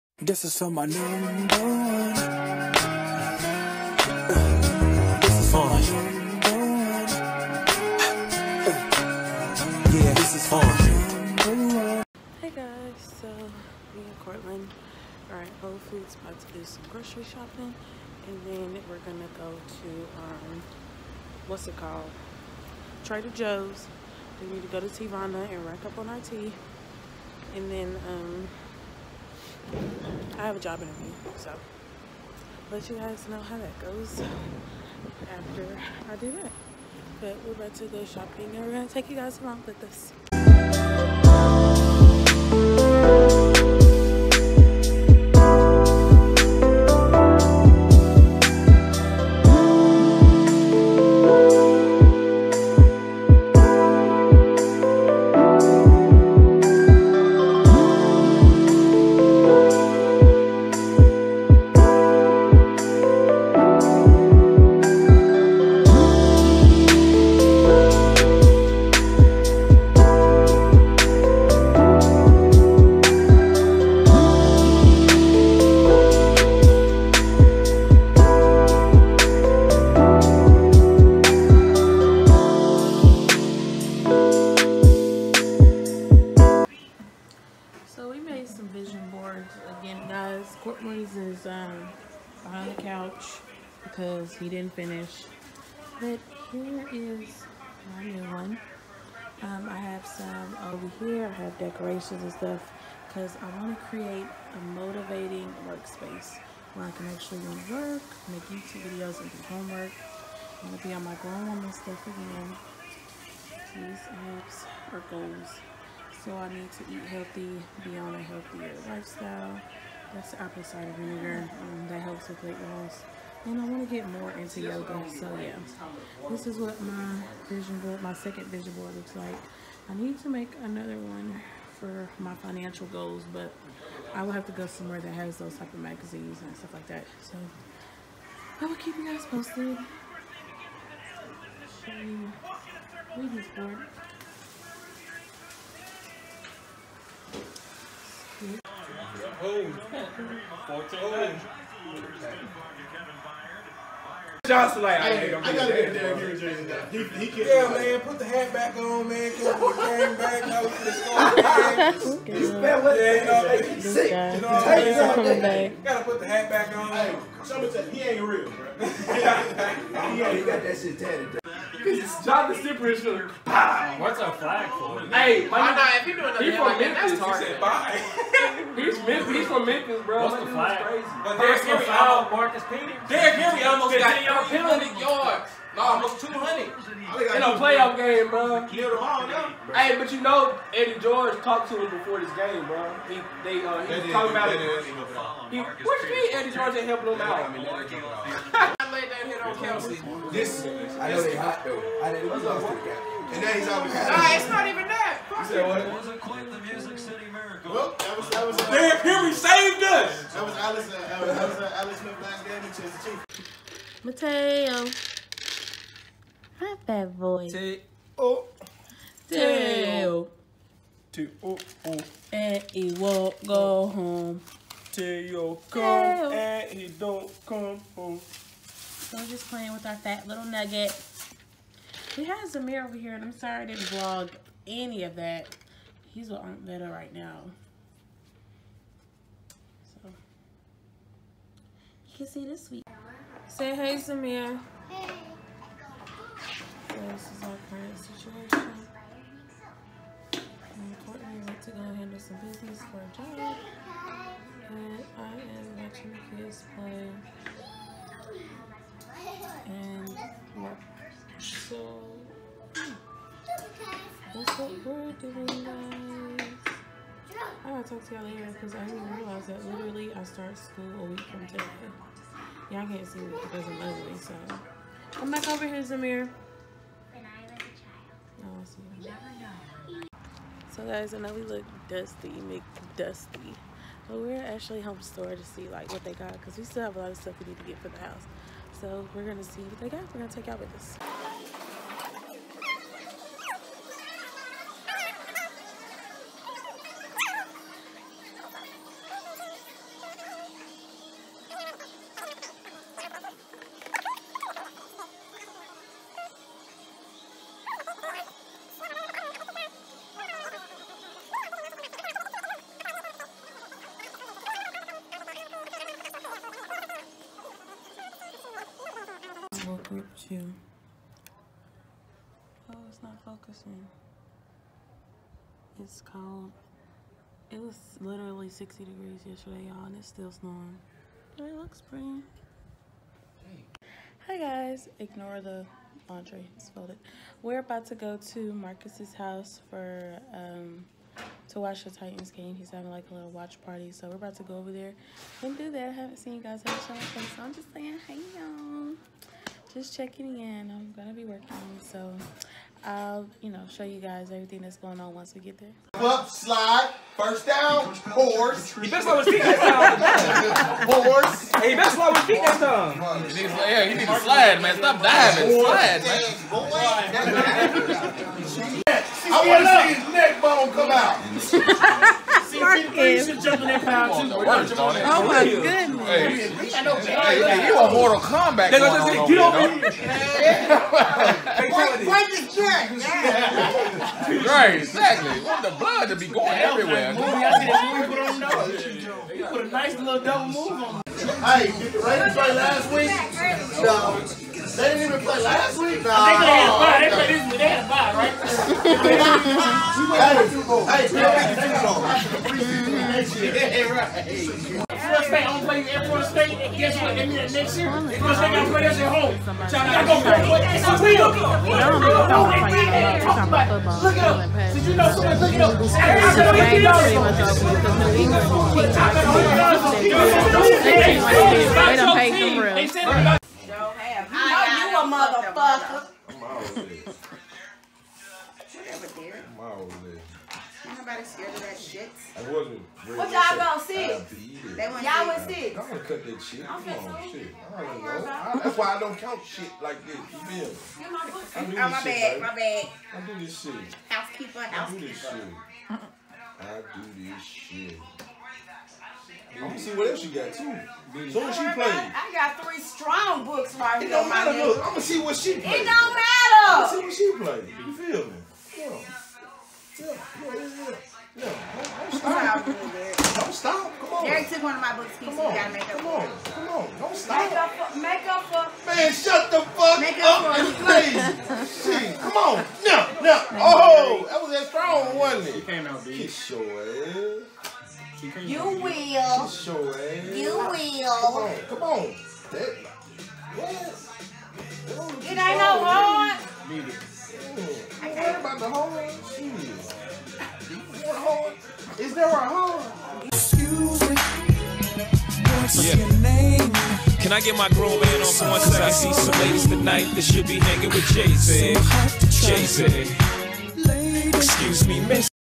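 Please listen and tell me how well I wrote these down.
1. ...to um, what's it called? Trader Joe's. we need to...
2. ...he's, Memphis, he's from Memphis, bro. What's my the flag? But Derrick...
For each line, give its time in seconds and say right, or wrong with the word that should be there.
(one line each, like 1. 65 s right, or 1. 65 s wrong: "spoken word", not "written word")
1. 19 s right
2. 178 s right.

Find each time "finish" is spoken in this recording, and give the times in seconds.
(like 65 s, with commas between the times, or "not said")
94 s.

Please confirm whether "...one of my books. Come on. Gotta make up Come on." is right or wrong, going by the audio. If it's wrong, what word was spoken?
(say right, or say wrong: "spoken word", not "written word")
right.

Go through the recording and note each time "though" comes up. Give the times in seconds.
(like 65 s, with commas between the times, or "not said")
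201 s.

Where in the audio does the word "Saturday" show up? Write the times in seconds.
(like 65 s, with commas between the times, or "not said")
415 s.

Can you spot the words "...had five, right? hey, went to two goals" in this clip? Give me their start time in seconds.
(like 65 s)
397 s.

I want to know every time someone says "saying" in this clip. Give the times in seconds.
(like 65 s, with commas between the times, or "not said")
165 s, 347 s.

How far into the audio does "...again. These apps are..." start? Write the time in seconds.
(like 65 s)
112 s.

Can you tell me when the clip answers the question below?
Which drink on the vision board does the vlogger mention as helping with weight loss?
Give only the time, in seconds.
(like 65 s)
120 s.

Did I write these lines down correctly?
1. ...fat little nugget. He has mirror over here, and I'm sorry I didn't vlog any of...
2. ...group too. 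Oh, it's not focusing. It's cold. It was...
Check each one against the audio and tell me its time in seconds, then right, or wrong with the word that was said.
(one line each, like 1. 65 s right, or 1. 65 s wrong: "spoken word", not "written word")
1. 229 s right
2. 319 s right.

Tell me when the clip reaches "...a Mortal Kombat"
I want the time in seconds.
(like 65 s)
377 s.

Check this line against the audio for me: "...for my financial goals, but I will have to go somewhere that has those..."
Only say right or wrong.
right.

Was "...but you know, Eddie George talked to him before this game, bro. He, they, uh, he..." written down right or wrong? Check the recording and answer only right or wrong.
right.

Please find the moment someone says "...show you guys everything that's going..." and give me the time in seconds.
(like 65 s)
353 s.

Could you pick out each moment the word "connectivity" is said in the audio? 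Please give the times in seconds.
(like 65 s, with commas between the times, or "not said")
not said.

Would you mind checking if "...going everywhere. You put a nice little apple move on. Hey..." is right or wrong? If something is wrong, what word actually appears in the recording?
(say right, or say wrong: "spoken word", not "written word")
wrong: "double", not "apple".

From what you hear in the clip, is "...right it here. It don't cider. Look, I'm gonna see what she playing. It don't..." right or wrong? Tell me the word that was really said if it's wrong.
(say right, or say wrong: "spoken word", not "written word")
wrong: "matter", not "cider".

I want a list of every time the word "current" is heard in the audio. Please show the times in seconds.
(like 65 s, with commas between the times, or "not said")
247 s.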